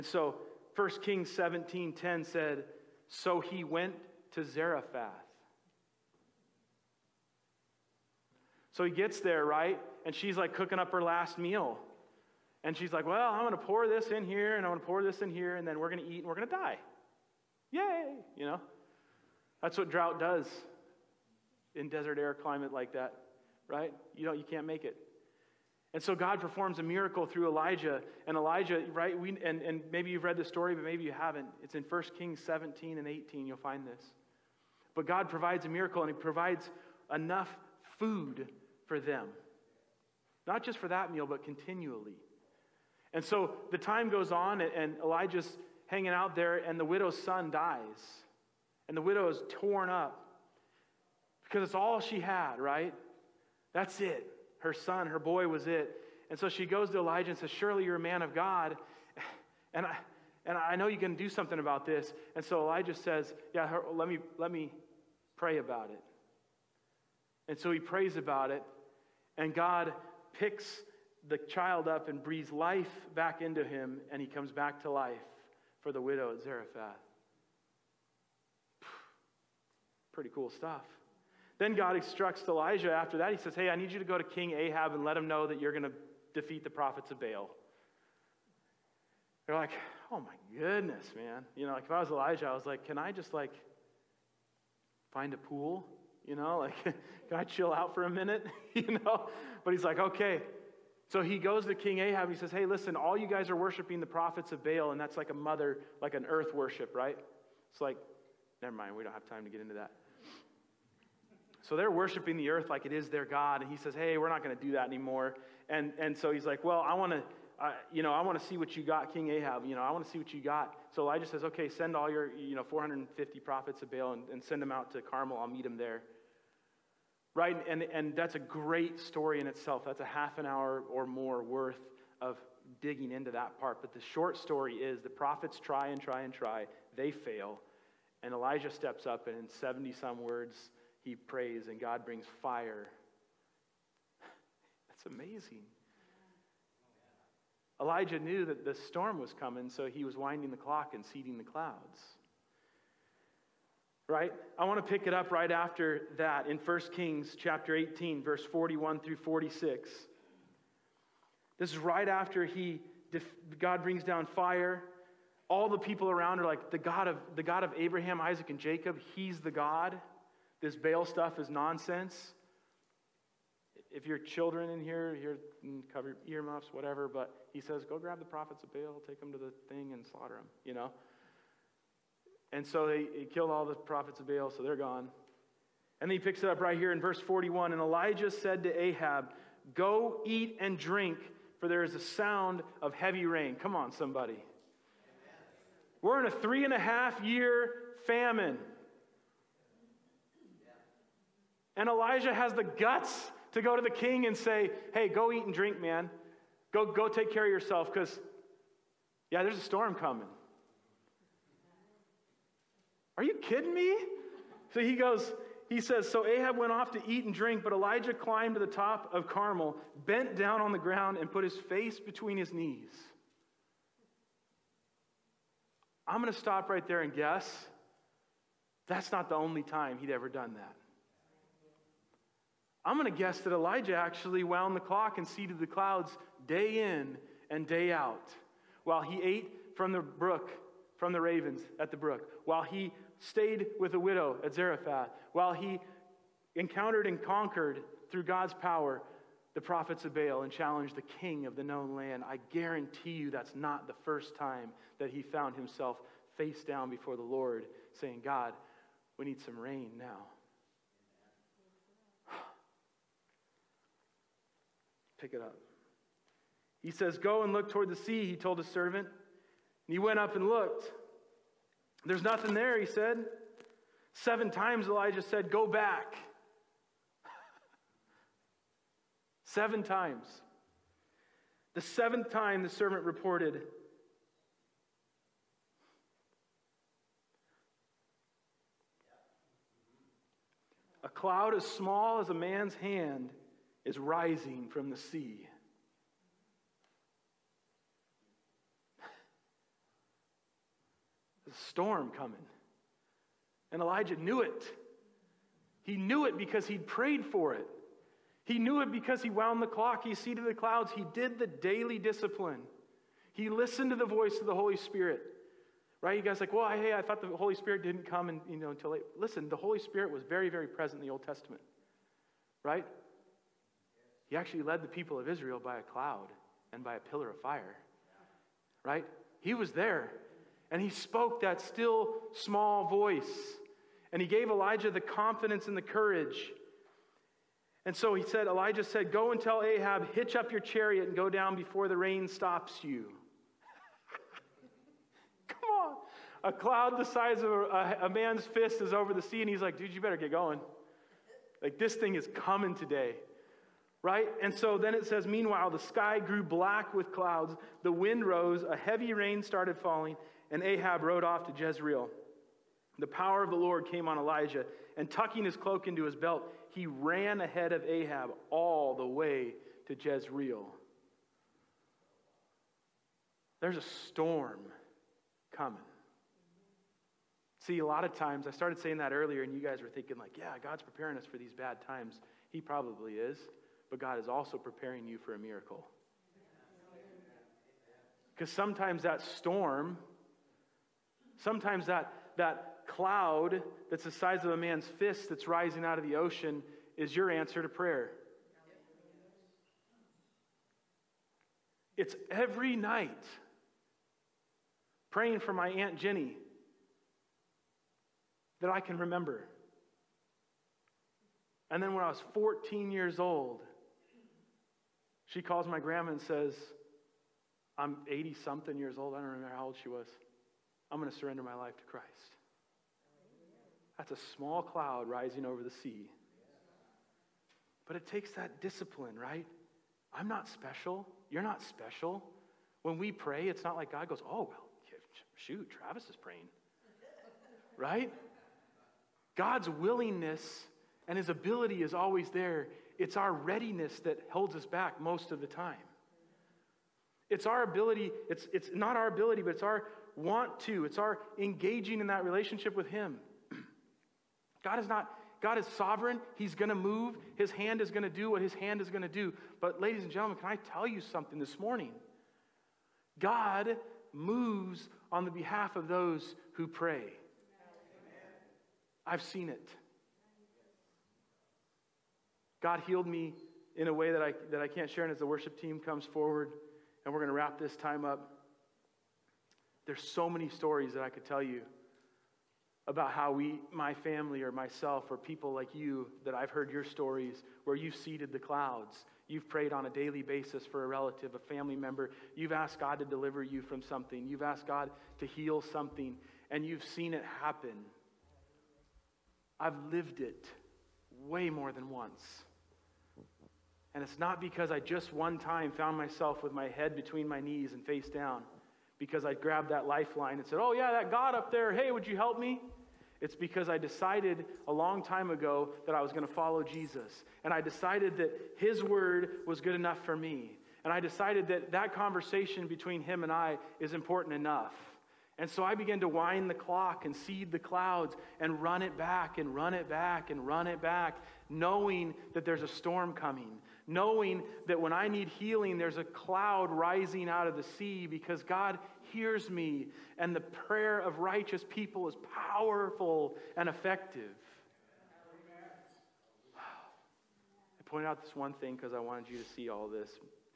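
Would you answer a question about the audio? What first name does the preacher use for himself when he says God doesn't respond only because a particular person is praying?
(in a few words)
Travis.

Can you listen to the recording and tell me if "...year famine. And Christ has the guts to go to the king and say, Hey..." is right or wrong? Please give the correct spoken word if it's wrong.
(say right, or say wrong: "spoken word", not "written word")
wrong: "Elijah", not "Christ".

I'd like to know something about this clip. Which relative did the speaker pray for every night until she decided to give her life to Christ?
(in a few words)
Aunt Jenny.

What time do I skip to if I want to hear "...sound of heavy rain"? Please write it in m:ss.
3:11.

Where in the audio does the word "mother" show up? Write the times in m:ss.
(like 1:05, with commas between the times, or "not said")
1:45.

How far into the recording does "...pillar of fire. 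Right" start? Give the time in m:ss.
5:27.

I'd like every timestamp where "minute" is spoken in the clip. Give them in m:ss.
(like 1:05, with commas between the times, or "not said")
1:38.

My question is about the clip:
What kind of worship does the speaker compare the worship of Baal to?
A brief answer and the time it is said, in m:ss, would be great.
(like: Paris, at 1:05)
earth worship, at 1:46.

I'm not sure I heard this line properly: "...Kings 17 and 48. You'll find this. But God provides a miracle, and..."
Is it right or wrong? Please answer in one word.
wrong.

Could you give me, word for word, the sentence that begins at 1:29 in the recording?
They're like, Oh my goodness, man.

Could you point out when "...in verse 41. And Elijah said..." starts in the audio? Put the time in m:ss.
3:06.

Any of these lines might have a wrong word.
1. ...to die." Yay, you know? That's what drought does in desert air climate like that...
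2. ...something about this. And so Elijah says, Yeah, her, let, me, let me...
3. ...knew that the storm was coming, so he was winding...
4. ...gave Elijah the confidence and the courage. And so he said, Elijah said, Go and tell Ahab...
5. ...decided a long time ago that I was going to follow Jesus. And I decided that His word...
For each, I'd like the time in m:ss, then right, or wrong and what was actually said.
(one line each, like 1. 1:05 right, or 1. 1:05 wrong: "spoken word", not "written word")
1. 0:16 right
2. 1:01 right
3. 2:28 right
4. 5:34 right
5. 8:33 right.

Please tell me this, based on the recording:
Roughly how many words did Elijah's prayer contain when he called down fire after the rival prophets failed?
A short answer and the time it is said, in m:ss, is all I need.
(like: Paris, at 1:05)
70 some, at 2:19.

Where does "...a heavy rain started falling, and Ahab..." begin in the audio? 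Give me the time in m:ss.
5:58.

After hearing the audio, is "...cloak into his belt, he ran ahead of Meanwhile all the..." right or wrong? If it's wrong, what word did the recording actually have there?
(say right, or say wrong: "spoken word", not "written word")
wrong: "Ahab", not "Meanwhile".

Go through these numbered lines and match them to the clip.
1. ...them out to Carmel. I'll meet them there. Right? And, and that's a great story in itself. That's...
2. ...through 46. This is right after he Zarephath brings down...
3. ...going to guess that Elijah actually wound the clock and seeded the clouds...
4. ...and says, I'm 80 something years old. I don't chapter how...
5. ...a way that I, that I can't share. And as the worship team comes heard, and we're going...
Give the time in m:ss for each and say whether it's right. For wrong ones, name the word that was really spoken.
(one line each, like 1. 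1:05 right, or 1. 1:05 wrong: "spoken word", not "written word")
1. 2:04 right
2. 2:38 wrong: "God", not "Zarephath"
3. 3:52 right
4. 6:56 wrong: "remember", not "chapter"
5. 7:53 wrong: "forward", not "heard".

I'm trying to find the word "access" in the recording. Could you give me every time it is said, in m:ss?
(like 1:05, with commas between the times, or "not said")
not said.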